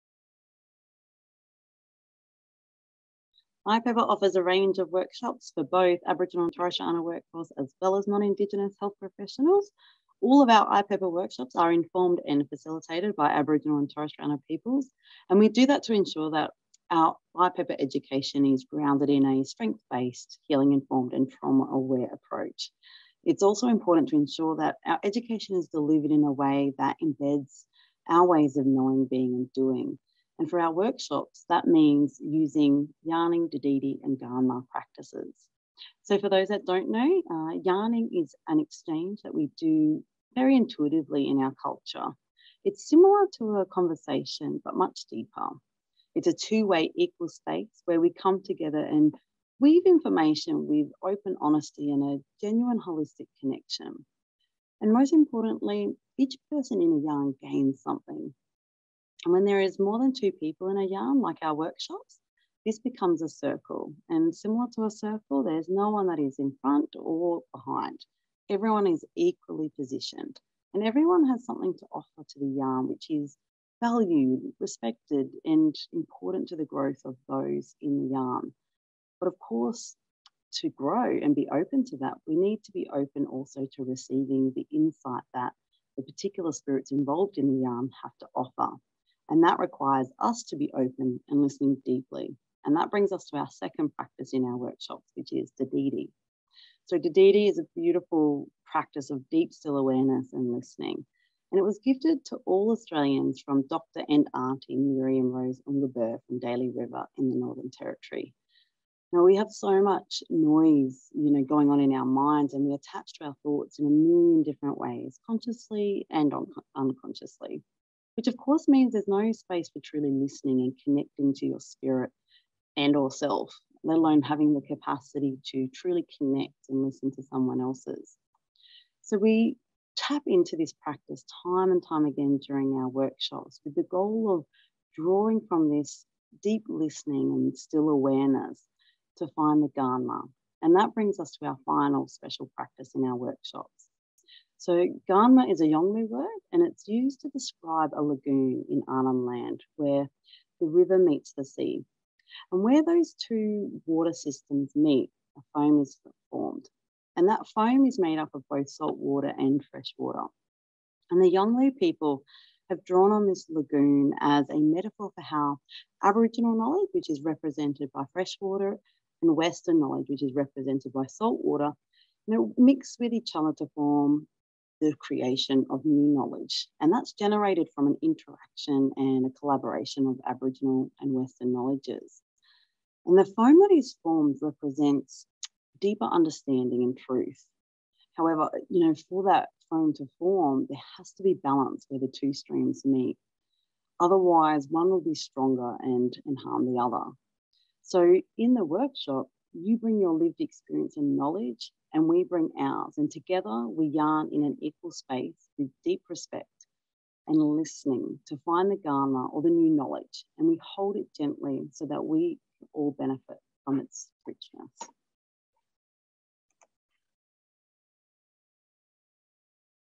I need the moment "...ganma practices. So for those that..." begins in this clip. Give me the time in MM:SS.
00:34.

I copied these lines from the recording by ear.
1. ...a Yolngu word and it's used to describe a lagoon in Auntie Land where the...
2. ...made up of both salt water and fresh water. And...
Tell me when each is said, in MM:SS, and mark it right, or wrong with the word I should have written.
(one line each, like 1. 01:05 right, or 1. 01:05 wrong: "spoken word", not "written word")
1. 02:25 wrong: "Arnhem", not "Auntie"
2. 02:37 right.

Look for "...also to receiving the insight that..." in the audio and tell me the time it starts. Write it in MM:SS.
01:23.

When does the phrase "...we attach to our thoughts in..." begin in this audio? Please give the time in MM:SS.
01:52.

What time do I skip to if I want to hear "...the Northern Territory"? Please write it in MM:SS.
01:47.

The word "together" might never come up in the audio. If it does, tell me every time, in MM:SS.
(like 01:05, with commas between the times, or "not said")
00:48, 03:23.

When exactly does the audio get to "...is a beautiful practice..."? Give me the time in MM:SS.
01:37.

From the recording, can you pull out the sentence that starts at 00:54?
And most importantly, each person in a yarn gains something.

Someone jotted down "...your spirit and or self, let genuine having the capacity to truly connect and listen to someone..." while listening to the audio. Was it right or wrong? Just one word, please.
wrong.